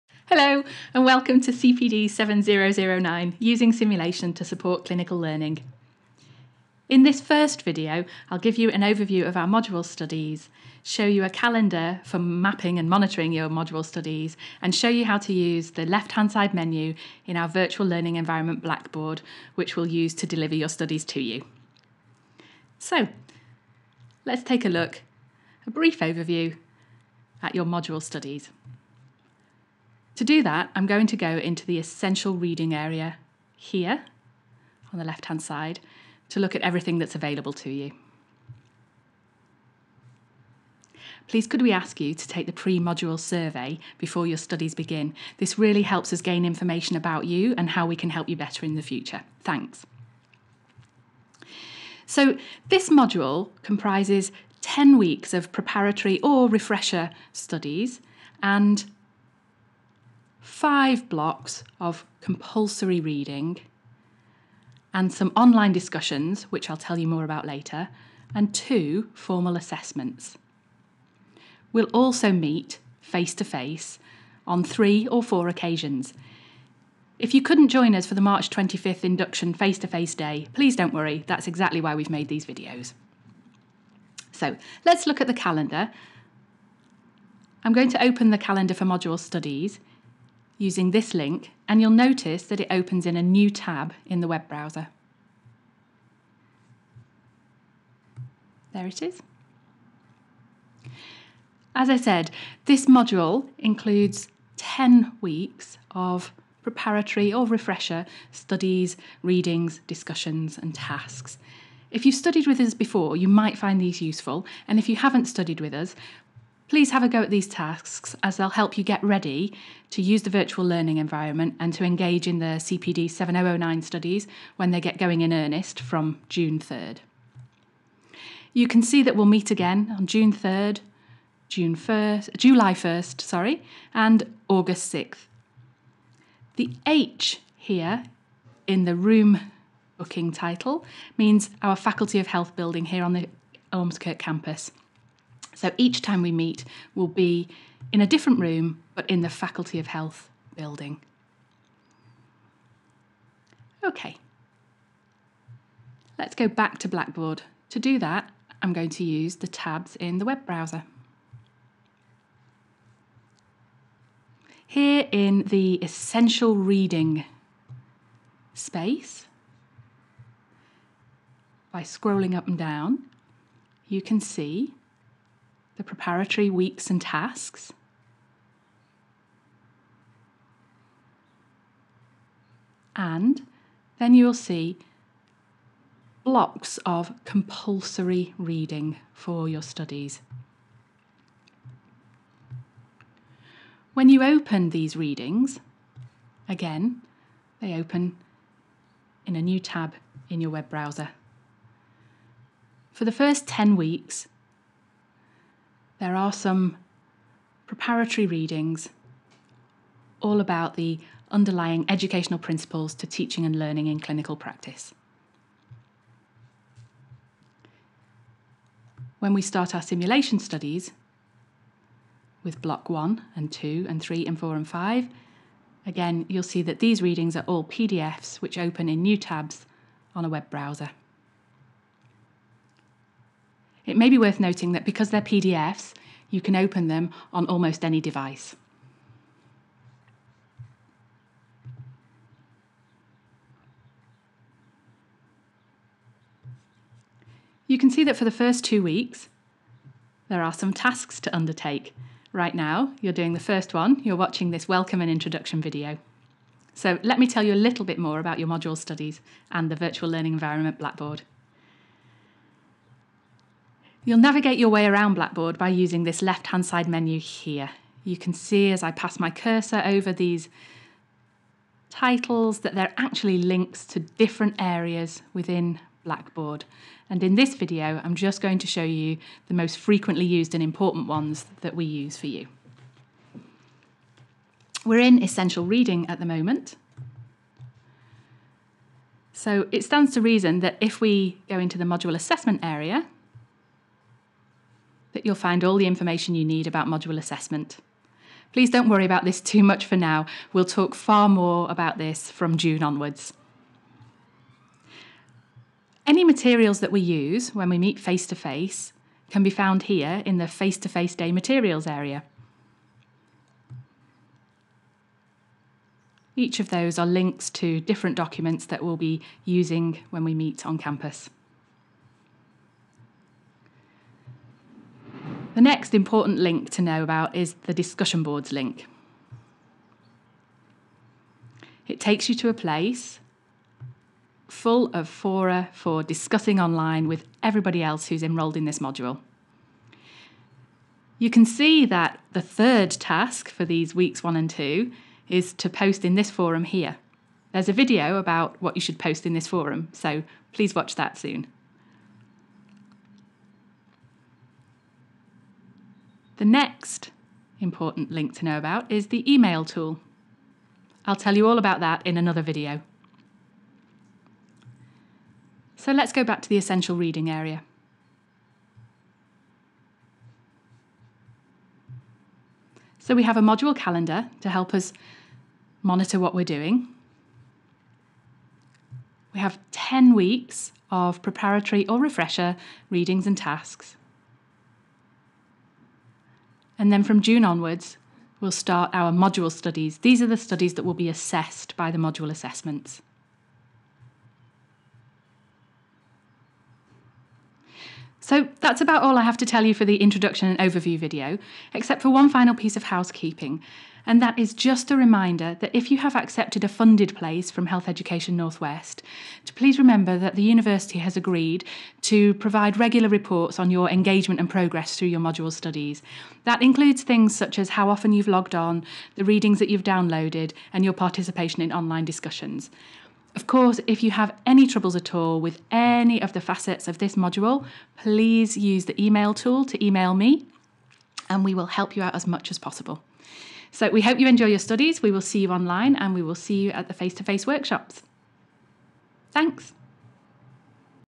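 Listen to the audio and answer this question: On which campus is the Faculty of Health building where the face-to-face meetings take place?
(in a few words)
Ormskirk.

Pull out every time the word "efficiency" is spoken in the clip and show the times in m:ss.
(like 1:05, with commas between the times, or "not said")
not said.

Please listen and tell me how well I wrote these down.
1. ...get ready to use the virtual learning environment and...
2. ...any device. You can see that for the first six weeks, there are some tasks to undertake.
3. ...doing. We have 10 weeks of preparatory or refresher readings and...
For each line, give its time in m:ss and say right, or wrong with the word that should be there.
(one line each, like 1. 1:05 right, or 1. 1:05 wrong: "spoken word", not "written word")
1. 1:58 right
2. 3:57 wrong: "two", not "six"
3. 6:16 right.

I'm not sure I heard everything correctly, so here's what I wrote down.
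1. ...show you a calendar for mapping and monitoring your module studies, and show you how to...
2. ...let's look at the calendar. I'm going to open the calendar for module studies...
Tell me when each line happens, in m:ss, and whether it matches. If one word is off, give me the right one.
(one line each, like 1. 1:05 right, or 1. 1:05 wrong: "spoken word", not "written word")
1. 0:10 right
2. 1:24 right.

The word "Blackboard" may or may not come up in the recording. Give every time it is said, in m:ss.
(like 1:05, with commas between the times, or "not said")
0:18, 2:36, 4:20, 4:25, 4:36.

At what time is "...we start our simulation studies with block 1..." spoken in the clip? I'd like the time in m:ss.
3:39.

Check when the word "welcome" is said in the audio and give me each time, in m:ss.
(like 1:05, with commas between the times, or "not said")
0:01, 4:14.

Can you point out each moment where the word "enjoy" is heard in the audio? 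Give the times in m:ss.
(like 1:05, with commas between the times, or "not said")
7:14.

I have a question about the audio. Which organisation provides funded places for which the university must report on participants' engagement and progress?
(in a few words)
Health Education Northwest.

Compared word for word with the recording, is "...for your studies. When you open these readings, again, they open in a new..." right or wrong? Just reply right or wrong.
right.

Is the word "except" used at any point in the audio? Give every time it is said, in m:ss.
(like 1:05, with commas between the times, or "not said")
6:41.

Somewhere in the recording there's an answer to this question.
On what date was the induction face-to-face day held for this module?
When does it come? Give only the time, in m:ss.
1:18.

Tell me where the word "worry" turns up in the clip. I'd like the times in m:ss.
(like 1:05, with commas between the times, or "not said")
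1:20, 4:58.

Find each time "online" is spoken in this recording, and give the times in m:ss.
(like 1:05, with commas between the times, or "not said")
1:05, 5:36, 7:01, 7:15.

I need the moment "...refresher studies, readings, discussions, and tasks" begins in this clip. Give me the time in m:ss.
1:47.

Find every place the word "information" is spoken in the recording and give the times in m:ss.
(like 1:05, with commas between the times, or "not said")
0:46, 4:55.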